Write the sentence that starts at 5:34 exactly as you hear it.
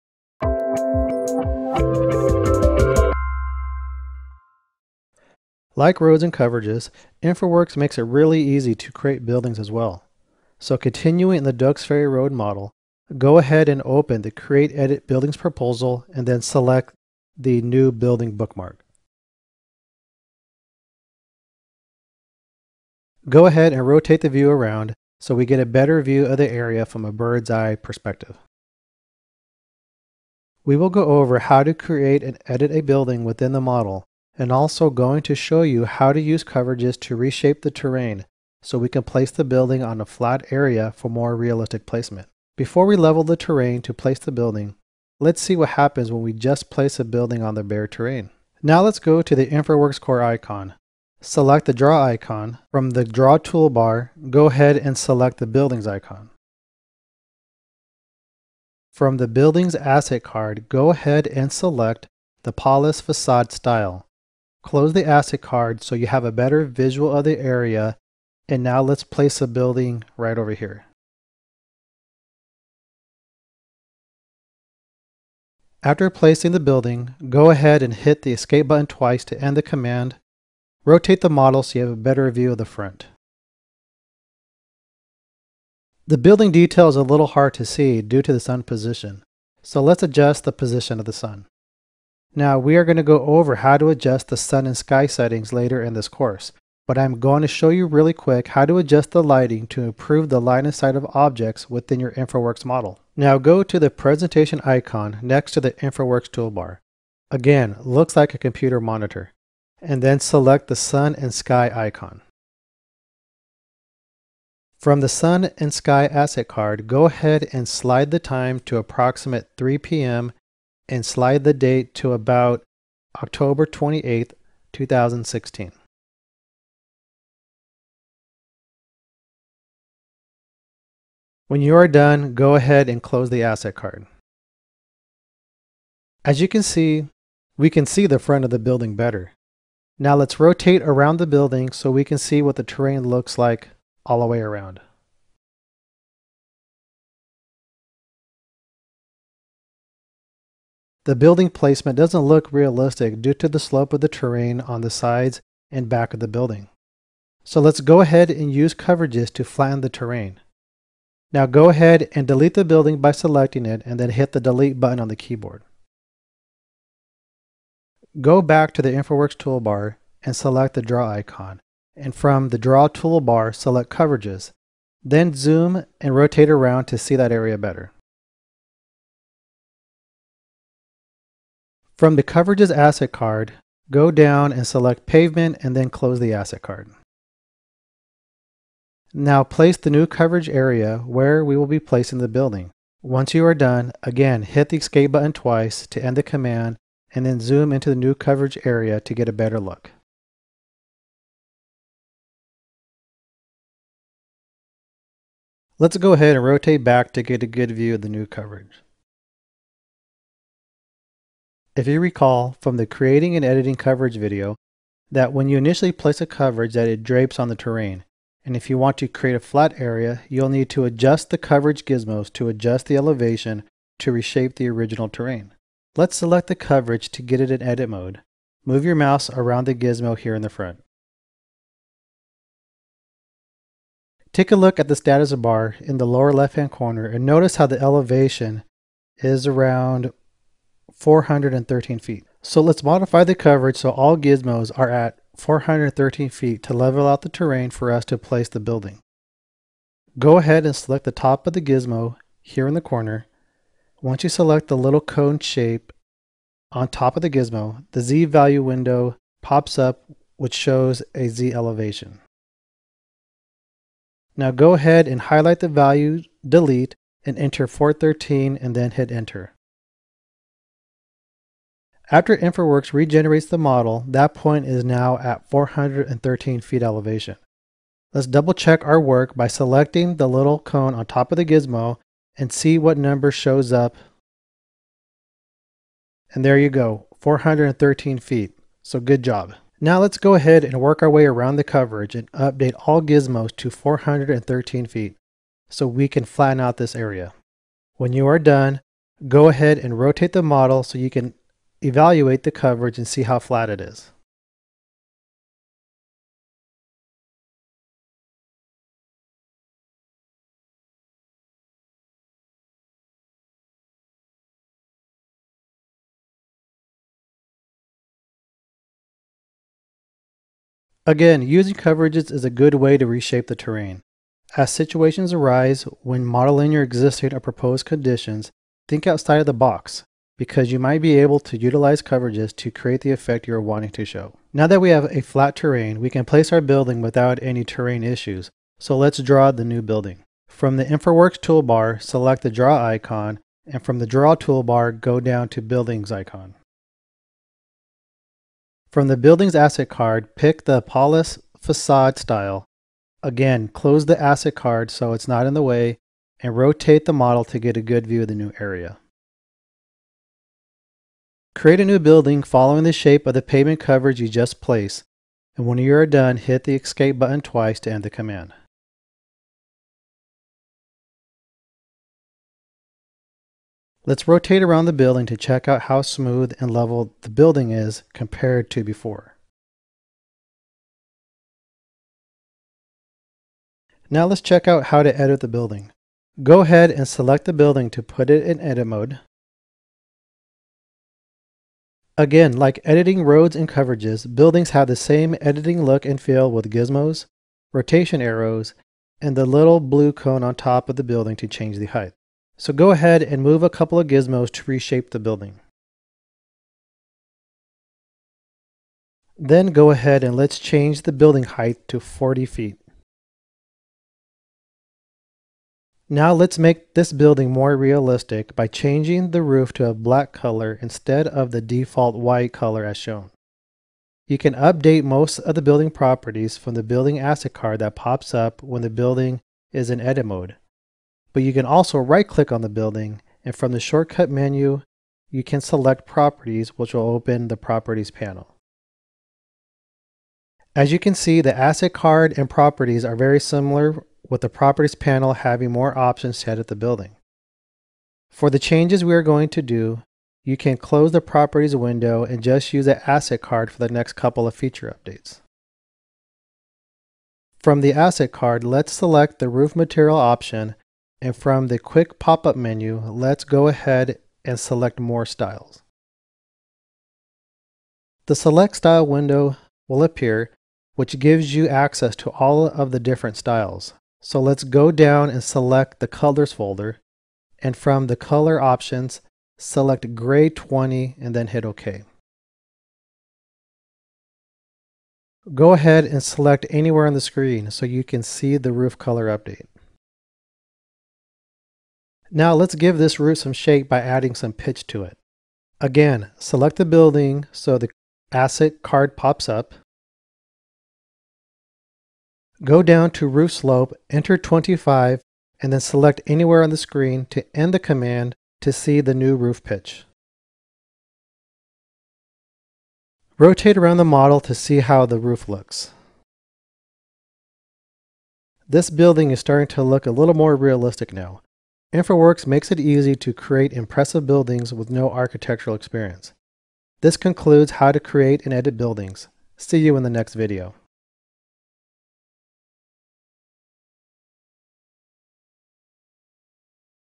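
Now that we have a flat terrain, we can place our building without any terrain issues, so let's draw the new building.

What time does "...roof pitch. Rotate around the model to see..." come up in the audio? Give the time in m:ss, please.
8:29.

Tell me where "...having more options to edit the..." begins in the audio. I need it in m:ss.
7:25.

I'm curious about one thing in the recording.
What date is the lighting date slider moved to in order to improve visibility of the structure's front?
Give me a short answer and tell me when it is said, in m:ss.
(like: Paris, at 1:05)
October 28, 2016, at 2:03.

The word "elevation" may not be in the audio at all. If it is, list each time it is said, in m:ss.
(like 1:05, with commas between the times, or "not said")
3:42, 3:57, 4:21, 4:36.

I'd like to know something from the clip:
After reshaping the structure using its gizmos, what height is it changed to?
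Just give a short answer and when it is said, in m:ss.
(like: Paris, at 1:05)
40 feet, at 6:51.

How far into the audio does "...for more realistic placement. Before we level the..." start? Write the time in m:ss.
0:40.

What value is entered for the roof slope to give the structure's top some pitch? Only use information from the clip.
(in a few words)
25.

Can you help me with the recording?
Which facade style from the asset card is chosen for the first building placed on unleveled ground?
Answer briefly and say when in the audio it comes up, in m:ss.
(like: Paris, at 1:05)
Polis, at 1:02.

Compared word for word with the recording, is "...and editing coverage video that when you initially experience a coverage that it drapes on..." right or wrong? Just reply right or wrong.
wrong.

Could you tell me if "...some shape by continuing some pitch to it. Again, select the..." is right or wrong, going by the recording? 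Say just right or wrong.
wrong.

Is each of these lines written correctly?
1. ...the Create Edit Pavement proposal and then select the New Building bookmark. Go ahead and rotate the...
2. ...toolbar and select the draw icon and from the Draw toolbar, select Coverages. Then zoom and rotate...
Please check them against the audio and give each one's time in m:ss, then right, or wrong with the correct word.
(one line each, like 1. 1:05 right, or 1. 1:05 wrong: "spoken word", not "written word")
1. 0:14 wrong: "Buildings", not "Pavement"
2. 2:49 right.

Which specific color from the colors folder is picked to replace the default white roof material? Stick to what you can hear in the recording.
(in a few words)
Gray 20.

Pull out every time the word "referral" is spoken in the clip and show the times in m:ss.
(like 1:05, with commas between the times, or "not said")
not said.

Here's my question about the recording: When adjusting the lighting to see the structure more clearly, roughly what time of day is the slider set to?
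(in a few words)
3 p.m.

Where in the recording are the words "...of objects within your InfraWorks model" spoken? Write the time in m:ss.
1:40.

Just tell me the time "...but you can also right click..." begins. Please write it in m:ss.
7:11.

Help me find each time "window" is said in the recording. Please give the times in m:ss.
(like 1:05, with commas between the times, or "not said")
4:18, 7:31, 7:49.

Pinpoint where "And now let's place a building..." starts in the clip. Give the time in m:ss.
1:08.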